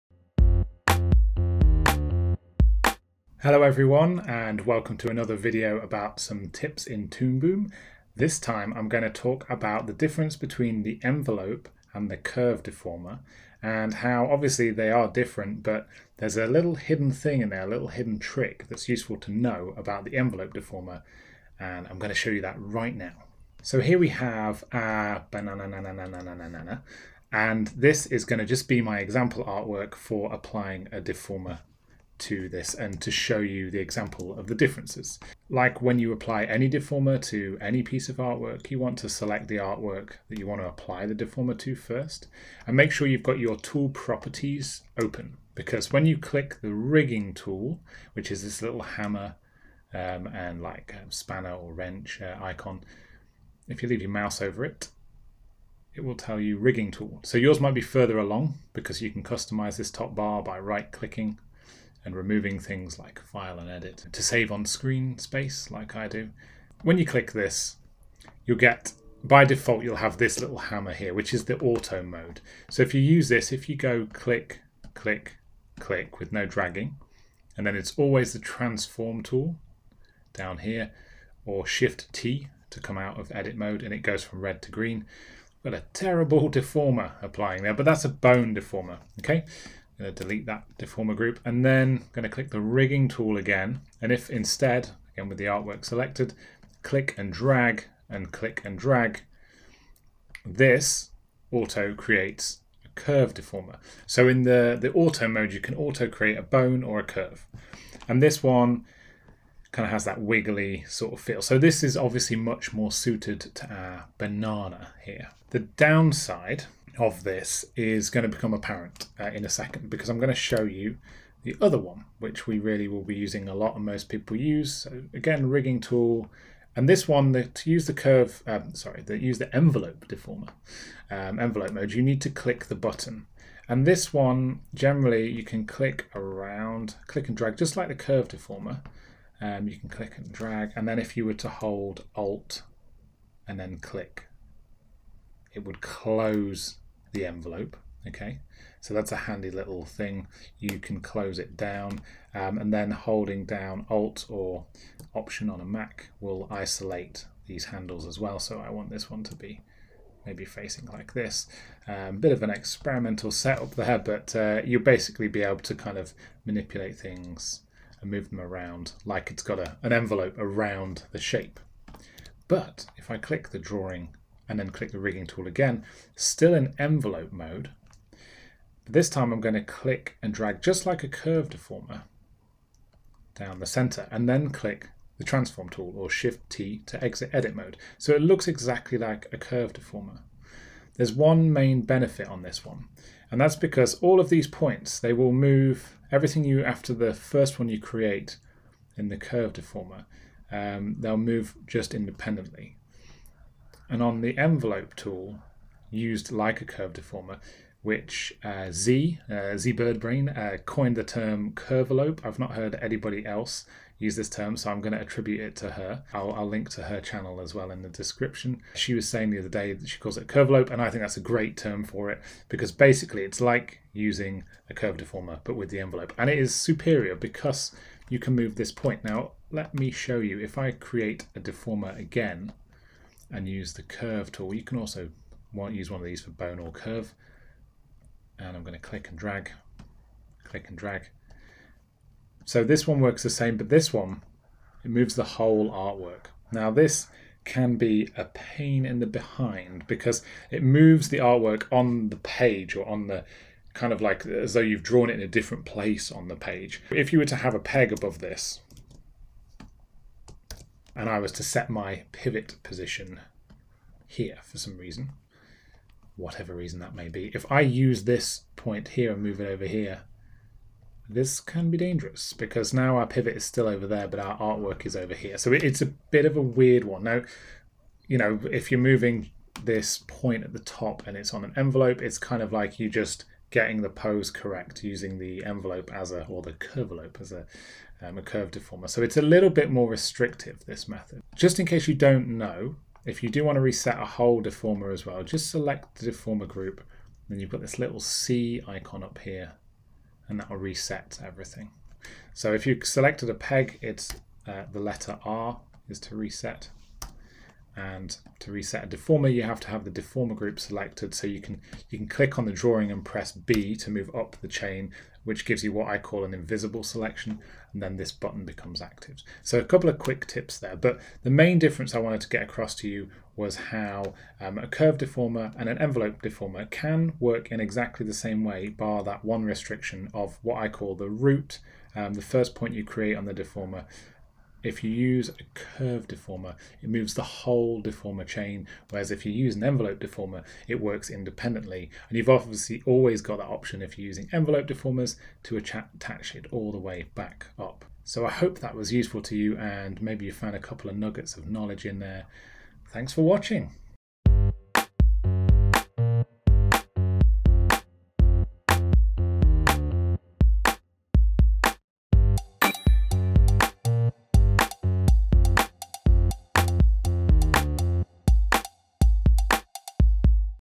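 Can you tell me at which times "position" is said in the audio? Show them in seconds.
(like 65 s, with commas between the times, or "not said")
262 s.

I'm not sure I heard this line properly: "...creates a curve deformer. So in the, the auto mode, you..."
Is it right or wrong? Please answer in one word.
right.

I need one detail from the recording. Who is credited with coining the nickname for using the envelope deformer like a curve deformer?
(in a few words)
ZeBirdbrain.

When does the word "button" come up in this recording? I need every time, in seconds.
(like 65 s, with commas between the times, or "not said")
132 s, 318 s.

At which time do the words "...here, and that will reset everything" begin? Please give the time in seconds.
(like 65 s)
299 s.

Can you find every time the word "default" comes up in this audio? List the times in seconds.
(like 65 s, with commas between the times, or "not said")
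69 s.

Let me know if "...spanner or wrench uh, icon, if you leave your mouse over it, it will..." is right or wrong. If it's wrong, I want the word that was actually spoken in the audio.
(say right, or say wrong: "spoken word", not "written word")
right.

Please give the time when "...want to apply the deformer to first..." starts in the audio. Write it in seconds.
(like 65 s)
40 s.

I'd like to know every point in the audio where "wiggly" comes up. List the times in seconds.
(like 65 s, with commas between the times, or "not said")
110 s.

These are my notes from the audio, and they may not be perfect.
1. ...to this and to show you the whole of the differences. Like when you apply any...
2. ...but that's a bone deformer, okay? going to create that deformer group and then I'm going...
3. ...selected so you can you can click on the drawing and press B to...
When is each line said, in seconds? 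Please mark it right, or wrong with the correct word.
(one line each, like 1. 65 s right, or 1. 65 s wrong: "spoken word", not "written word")
1. 32 s wrong: "example", not "whole"
2. 87 s wrong: "delete", not "create"
3. 310 s right.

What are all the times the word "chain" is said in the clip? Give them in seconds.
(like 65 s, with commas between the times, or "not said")
314 s, 338 s.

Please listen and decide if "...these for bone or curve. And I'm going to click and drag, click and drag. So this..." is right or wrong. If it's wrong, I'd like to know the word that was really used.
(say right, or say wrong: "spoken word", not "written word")
right.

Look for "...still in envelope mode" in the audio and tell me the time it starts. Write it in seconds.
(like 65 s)
176 s.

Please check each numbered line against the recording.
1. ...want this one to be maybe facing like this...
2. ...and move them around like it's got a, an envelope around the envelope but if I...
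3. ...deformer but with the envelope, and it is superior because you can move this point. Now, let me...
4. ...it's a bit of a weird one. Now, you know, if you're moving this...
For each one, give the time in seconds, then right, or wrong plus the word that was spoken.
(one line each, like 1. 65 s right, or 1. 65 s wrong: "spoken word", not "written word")
1. 158 s right
2. 168 s wrong: "shape", not "envelope"
3. 224 s right
4. 275 s right.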